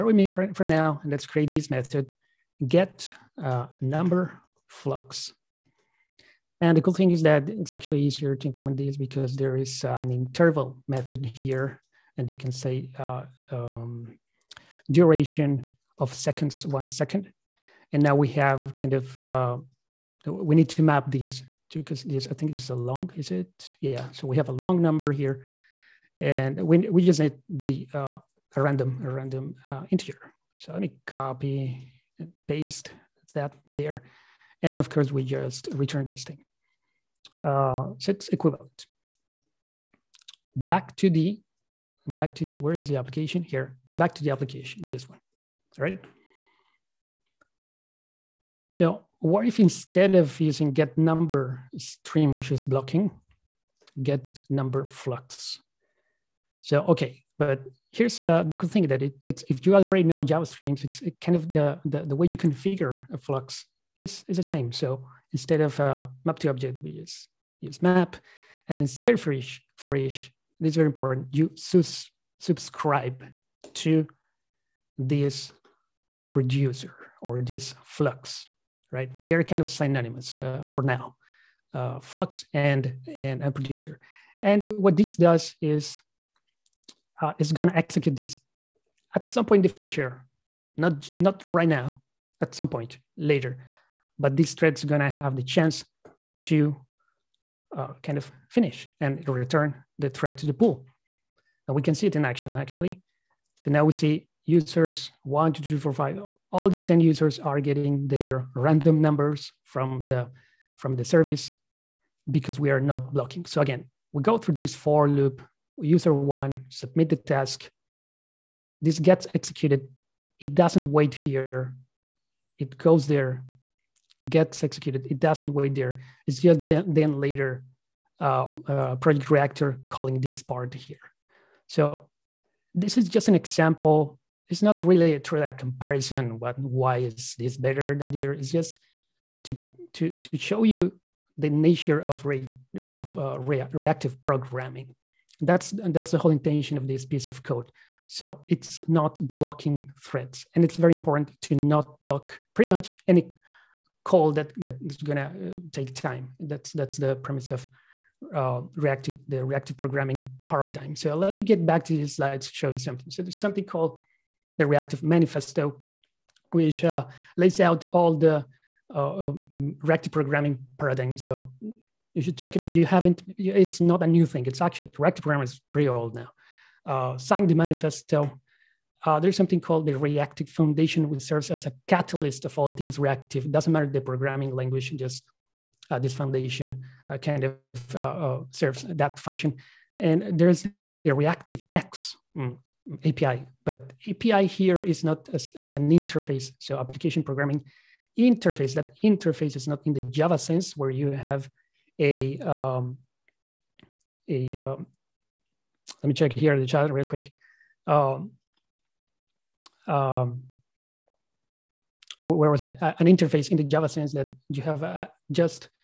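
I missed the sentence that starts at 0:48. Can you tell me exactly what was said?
So what if instead of using get number stream, which is blocking, get number flux?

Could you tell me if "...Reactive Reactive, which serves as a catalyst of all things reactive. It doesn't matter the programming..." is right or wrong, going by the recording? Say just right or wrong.
wrong.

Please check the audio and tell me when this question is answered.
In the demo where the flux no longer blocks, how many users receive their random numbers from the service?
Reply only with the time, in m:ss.
1:46.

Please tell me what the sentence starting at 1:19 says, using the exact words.
They're kind of synonymous uh, for now, uh, flux and, and and producer.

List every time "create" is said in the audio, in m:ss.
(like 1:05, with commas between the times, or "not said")
0:01.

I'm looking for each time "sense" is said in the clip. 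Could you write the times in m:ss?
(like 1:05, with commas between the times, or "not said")
3:20, 3:33.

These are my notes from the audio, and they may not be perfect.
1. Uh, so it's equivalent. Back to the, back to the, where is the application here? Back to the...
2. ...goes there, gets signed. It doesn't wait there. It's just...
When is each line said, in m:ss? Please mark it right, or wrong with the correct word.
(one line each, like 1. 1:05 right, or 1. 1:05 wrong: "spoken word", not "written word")
1. 0:37 right
2. 2:02 wrong: "executed", not "signed".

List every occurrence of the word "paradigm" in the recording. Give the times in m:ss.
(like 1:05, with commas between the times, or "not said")
2:40, 2:50.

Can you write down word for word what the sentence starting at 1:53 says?
So again, we go through this for loop, user one, submit the task.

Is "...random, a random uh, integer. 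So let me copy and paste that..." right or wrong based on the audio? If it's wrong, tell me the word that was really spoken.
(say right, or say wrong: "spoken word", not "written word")
right.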